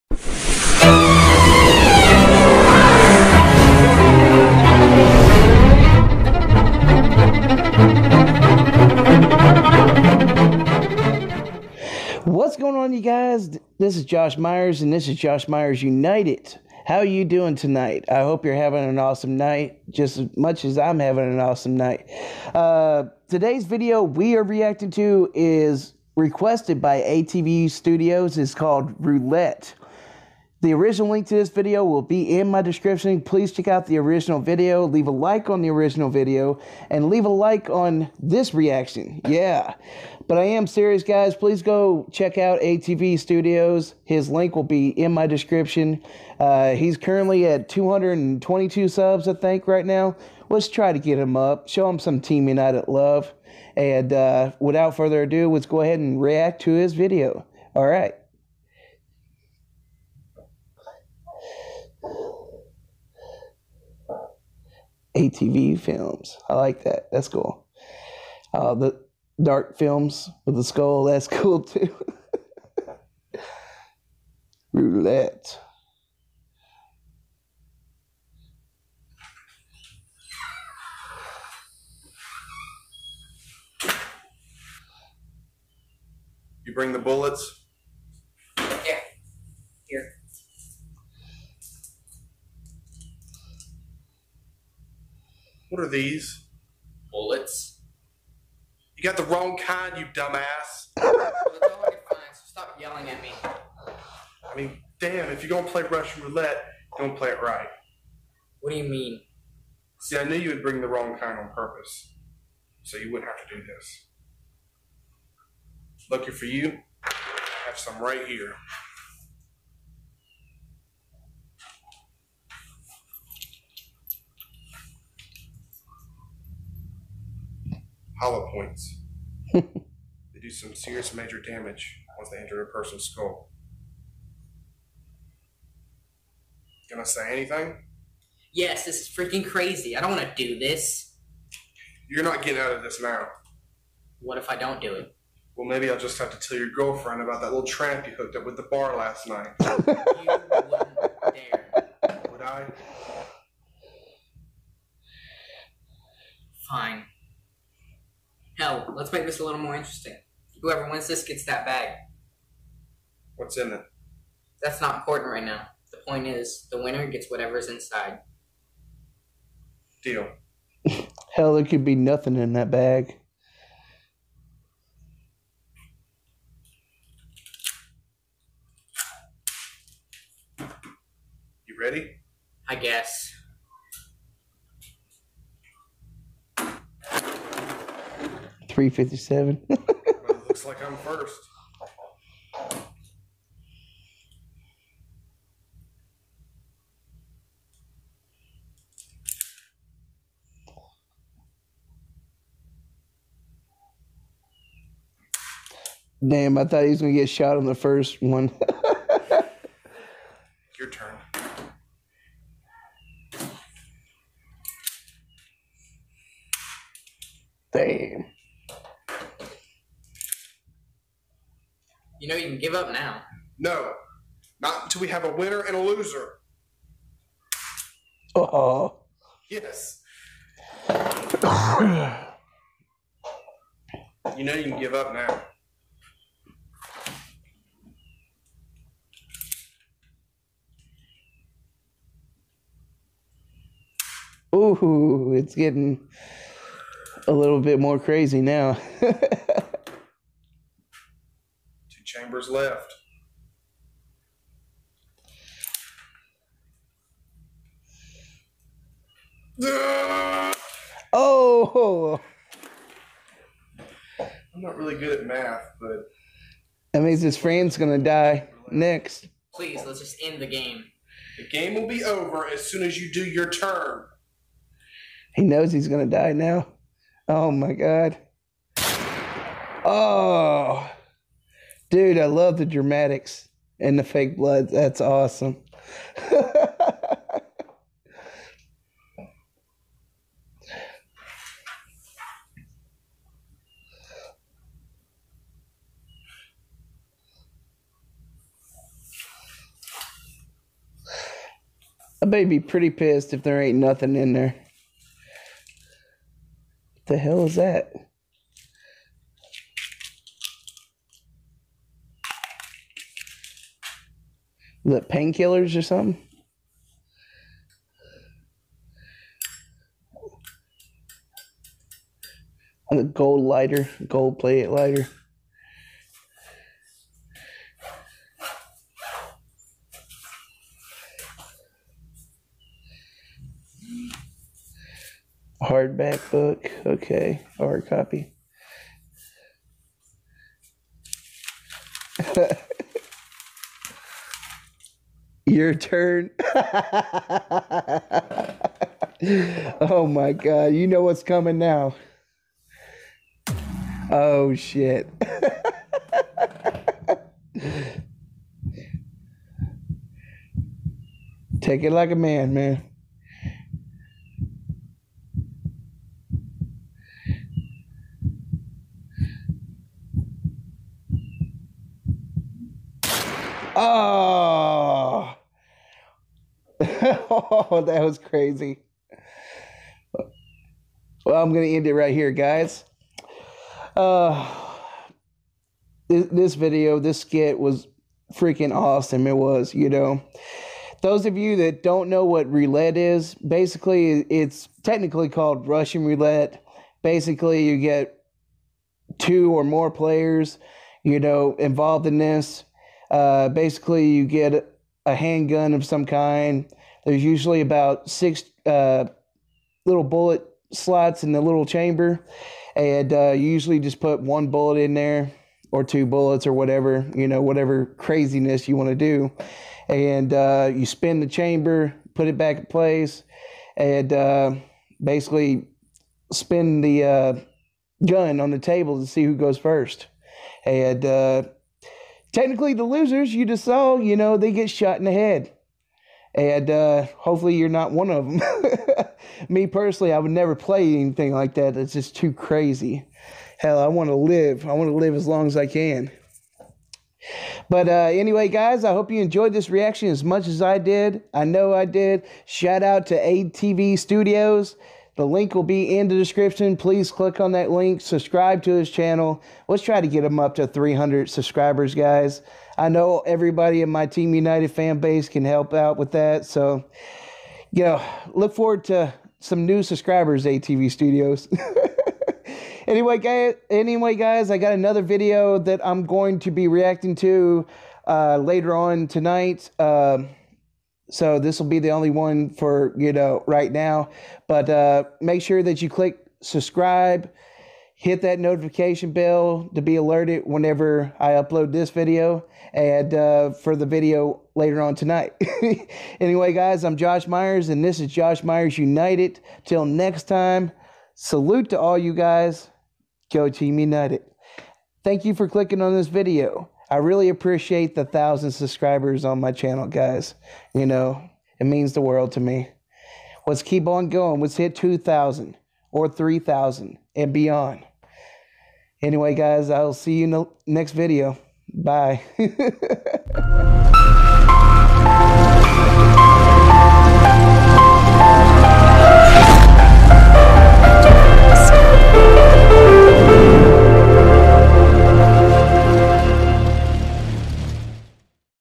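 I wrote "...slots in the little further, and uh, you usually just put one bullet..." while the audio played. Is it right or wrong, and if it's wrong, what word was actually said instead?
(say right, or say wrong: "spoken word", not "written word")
wrong: "chamber", not "further".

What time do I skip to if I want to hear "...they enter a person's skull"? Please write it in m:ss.
2:12.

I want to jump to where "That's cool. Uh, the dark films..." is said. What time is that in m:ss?
1:07.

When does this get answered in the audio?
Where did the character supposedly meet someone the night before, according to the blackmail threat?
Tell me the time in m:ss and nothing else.
2:28.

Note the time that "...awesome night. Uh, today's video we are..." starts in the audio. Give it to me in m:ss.
0:21.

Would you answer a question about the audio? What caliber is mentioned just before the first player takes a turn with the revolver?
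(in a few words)
357.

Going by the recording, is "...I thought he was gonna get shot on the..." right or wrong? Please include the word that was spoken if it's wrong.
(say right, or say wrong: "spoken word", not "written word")
right.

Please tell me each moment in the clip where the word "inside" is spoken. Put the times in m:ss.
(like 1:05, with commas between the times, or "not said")
2:47.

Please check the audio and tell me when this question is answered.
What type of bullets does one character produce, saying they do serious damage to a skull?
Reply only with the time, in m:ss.
2:08.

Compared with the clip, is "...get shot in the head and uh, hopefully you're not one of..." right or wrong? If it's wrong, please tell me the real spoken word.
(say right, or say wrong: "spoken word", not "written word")
right.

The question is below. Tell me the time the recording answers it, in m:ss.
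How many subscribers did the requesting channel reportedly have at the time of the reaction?
0:47.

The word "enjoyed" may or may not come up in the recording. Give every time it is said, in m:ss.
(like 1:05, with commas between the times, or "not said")
7:29.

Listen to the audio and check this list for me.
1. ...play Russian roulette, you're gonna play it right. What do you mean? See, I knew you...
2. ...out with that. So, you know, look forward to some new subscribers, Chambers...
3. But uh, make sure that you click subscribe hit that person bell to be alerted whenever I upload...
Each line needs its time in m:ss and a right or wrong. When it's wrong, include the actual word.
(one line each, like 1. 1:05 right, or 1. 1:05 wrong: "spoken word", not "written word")
1. 1:45 right
2. 7:45 wrong: "ATV", not "Chambers"
3. 8:04 wrong: "notification", not "person".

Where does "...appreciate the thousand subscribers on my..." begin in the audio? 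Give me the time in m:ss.
8:27.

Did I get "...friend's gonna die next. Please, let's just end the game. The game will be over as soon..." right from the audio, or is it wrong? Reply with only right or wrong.
right.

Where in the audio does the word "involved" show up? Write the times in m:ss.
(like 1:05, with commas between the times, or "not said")
6:41.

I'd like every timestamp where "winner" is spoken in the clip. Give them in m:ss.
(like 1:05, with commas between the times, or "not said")
2:46, 3:45.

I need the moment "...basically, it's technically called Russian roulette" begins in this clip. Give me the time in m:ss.
6:33.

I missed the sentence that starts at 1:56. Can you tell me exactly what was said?
Lucky for you, I have some right here.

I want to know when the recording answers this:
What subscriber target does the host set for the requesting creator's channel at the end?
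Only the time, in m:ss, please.
7:40.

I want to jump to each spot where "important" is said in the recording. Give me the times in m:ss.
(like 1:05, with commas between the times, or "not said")
2:44.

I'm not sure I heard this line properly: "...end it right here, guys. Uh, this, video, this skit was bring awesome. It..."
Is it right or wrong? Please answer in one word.
wrong.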